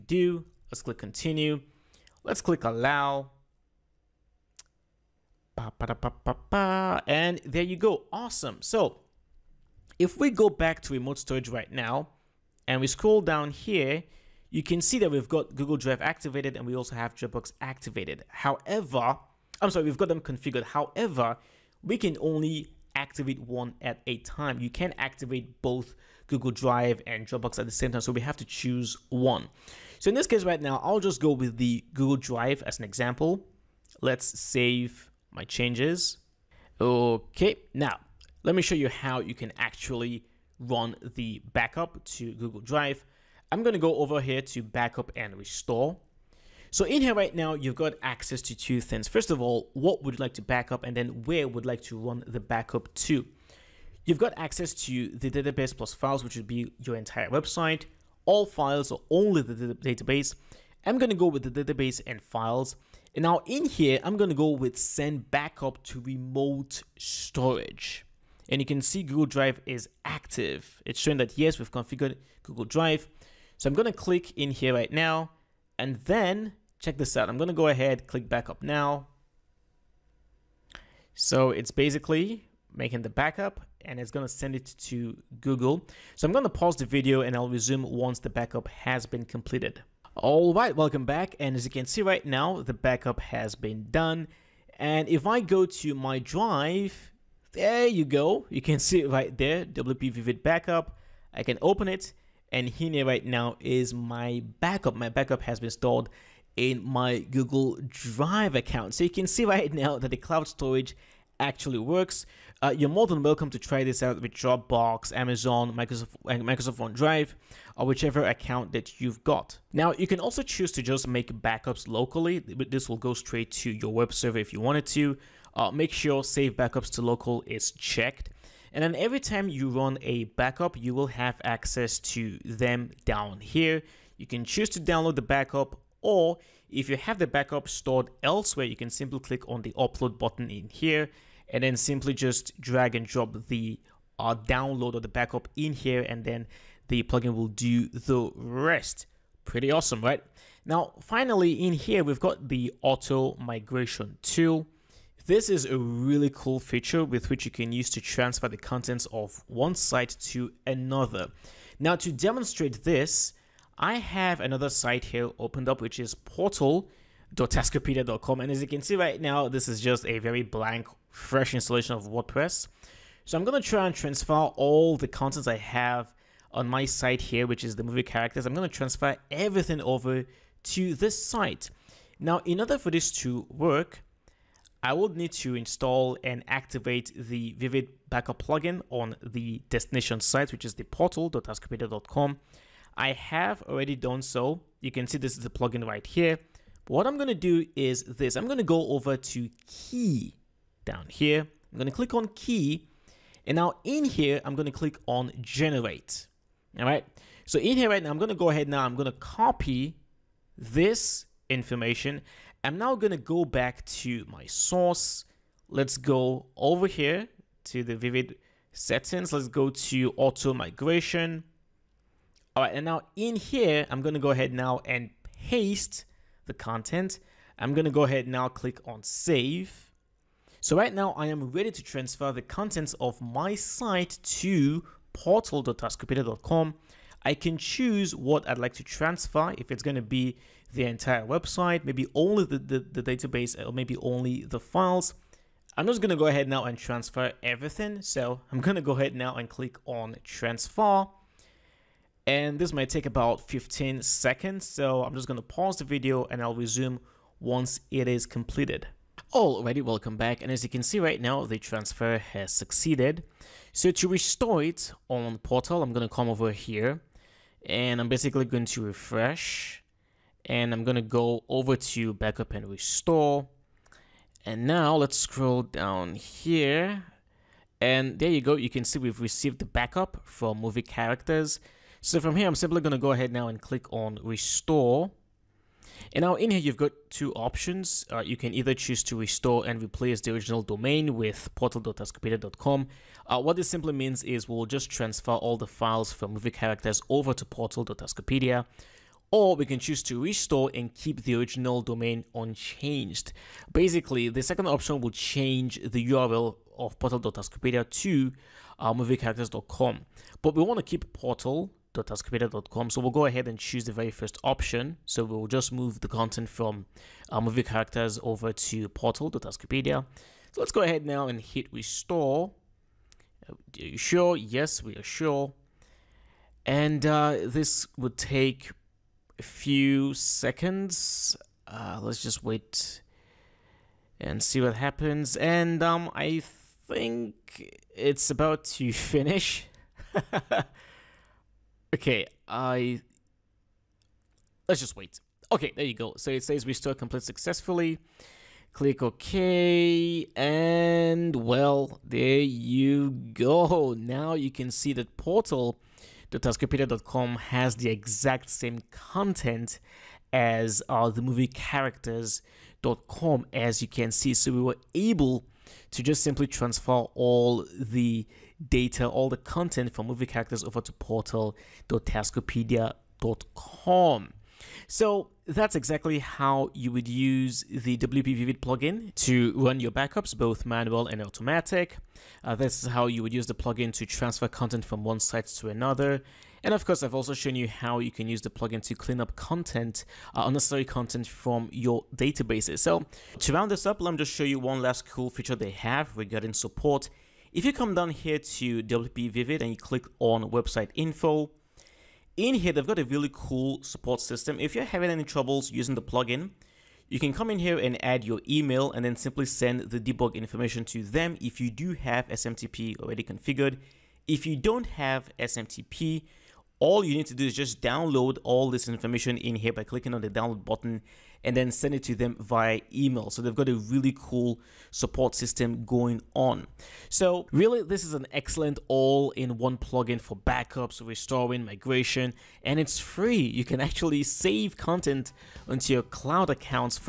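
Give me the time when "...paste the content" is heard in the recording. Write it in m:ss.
3:45.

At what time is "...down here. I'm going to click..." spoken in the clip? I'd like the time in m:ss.
3:20.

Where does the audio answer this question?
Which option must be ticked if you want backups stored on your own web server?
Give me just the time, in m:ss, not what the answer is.
2:06.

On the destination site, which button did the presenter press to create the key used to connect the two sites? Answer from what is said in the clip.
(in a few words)
generate.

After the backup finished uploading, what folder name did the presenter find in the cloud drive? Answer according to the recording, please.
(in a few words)
WP Vivid Backup.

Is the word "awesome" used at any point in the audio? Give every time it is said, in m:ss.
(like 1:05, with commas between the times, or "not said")
0:08, 2:29.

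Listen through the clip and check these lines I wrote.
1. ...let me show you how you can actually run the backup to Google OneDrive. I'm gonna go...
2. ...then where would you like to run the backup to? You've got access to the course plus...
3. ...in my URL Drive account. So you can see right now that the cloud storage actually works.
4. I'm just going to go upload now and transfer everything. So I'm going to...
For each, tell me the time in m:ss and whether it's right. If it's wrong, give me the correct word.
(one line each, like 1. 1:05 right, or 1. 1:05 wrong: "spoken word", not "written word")
1. 0:38 wrong: "Drive", not "OneDrive"
2. 0:50 wrong: "database", not "course"
3. 1:46 wrong: "Google", not "URL"
4. 4:05 wrong: "ahead", not "upload".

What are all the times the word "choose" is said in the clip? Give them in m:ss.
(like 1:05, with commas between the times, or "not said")
0:28, 2:00, 2:14, 3:57, 4:48, 4:59, 5:13.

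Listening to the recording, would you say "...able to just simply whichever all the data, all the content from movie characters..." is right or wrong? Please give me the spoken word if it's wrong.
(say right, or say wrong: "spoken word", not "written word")
wrong: "transfer", not "whichever".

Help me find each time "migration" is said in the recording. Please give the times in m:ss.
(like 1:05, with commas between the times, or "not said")
2:33, 3:40, 7:11.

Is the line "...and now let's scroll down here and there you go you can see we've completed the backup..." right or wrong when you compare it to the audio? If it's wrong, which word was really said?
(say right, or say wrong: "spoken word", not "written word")
wrong: "received", not "completed".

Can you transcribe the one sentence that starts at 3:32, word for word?
I'm now going to go back to my source.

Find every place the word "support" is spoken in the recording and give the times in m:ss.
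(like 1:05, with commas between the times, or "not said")
6:36, 6:43, 7:04.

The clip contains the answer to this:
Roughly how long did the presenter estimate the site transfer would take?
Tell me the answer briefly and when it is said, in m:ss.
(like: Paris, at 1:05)
15 seconds, at 4:13.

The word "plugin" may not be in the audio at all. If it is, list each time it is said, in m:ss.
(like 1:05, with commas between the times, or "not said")
2:27, 3:08, 3:15, 6:18, 6:23, 6:28, 6:46, 7:09.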